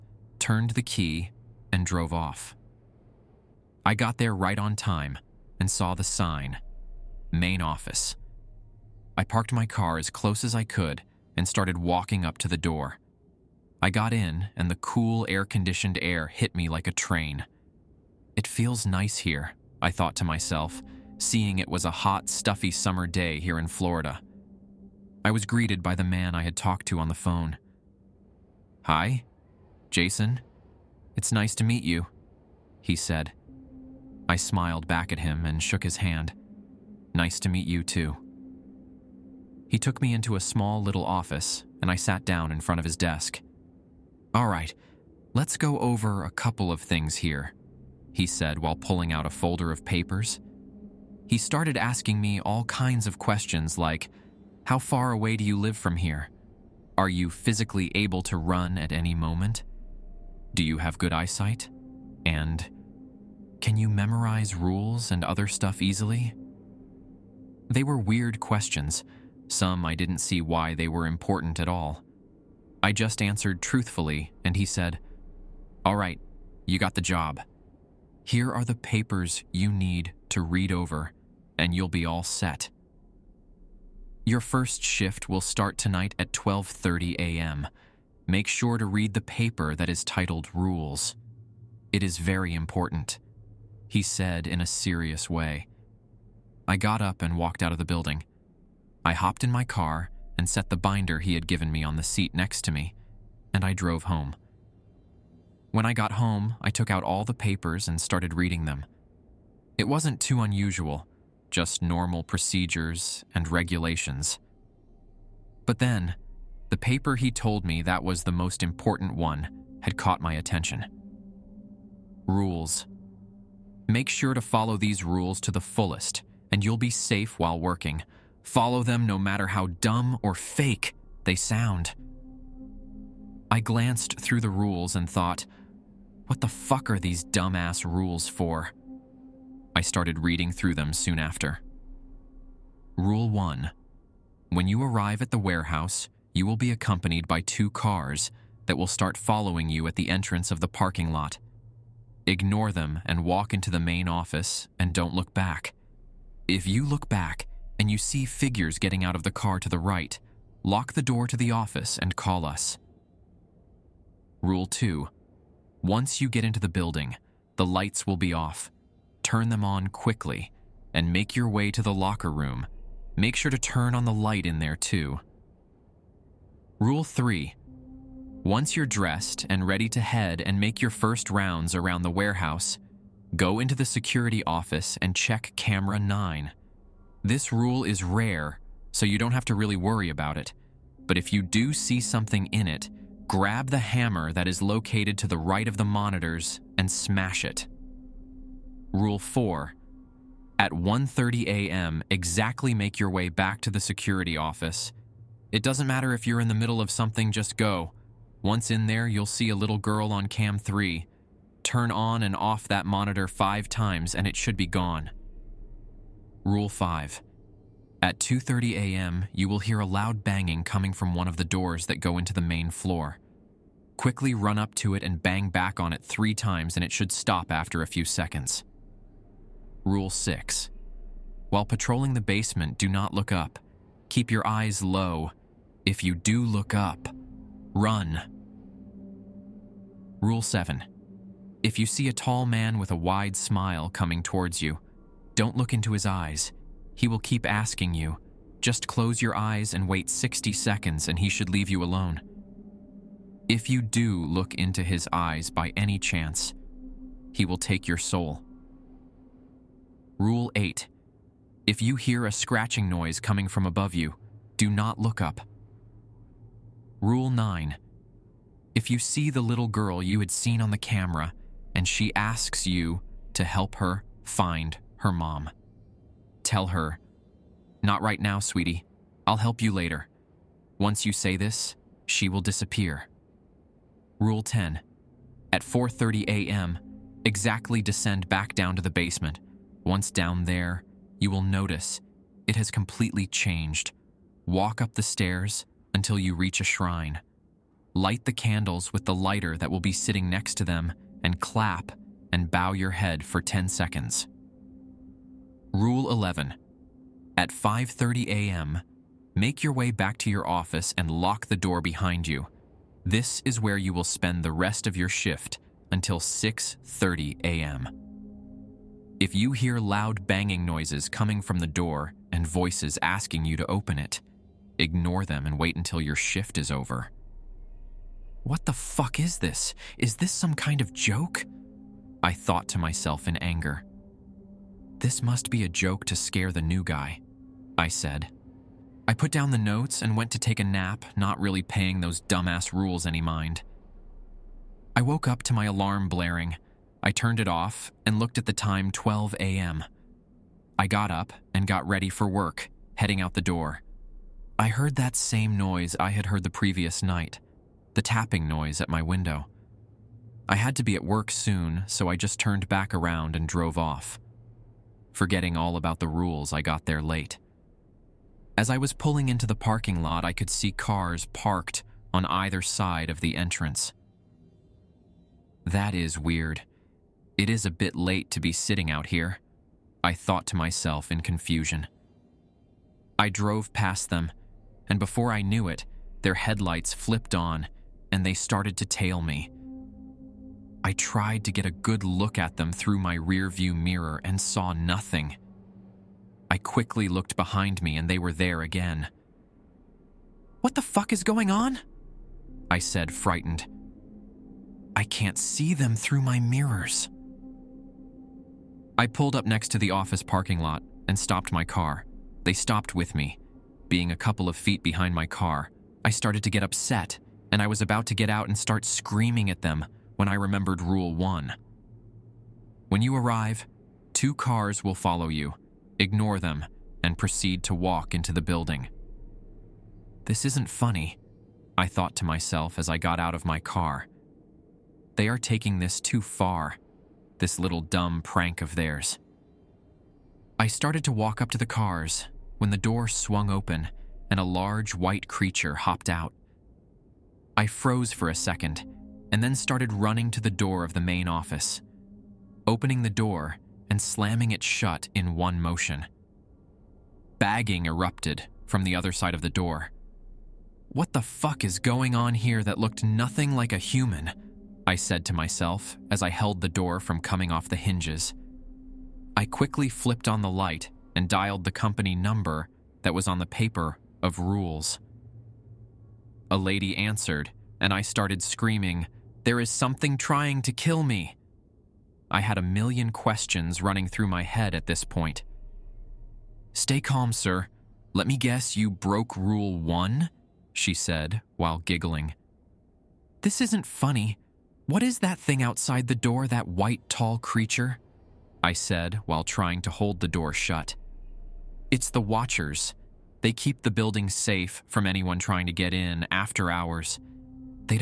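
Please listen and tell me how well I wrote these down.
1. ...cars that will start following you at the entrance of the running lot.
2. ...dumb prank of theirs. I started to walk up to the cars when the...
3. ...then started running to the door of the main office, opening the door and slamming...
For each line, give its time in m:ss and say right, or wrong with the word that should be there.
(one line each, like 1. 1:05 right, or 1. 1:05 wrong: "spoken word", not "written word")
1. 2:27 wrong: "parking", not "running"
2. 7:17 right
3. 7:29 right.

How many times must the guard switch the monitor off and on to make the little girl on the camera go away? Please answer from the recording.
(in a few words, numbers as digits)
5.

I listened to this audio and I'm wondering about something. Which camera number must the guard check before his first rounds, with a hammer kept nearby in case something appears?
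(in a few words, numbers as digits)
9.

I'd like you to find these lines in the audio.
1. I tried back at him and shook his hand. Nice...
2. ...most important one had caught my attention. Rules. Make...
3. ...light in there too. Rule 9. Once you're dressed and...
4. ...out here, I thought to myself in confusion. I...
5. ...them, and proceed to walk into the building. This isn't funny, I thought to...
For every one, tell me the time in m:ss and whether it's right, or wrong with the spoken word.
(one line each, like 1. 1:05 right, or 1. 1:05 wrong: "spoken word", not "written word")
1. 0:34 wrong: "smiled", not "tried"
2. 1:58 right
3. 2:54 wrong: "3", not "9"
4. 6:18 right
5. 7:06 right.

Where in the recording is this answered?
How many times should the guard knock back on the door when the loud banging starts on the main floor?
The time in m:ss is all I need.
3:46.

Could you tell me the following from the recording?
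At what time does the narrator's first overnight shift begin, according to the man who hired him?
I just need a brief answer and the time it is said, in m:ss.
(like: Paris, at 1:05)
12:30 a.m., at 1:26.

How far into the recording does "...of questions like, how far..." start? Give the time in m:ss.
0:53.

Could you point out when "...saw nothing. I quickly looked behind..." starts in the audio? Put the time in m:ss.
6:34.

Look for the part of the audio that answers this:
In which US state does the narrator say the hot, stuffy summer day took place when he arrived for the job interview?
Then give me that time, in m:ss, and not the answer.
0:23.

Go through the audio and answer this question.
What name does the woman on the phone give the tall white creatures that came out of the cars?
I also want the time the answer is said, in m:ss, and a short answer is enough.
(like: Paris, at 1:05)
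The Watchers, at 8:22.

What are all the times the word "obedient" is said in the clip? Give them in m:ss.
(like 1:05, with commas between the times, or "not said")
not said.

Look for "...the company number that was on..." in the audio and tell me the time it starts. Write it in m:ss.
7:51.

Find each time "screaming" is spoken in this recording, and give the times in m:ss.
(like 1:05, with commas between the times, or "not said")
6:58, 7:58.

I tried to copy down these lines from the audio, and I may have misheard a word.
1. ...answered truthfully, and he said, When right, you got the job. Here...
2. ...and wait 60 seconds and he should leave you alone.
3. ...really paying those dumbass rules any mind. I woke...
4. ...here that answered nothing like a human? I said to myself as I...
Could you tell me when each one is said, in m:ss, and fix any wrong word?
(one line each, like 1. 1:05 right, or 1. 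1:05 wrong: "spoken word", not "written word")
1. 1:13 wrong: "All", not "When"
2. 4:09 right
3. 5:41 right
4. 7:42 wrong: "looked", not "answered".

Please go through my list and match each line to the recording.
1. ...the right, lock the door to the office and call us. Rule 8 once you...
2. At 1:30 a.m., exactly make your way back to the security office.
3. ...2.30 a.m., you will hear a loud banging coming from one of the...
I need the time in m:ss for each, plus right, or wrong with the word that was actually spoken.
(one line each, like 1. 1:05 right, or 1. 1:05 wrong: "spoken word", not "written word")
1. 2:39 wrong: "2", not "8"
2. 3:20 right
3. 3:38 right.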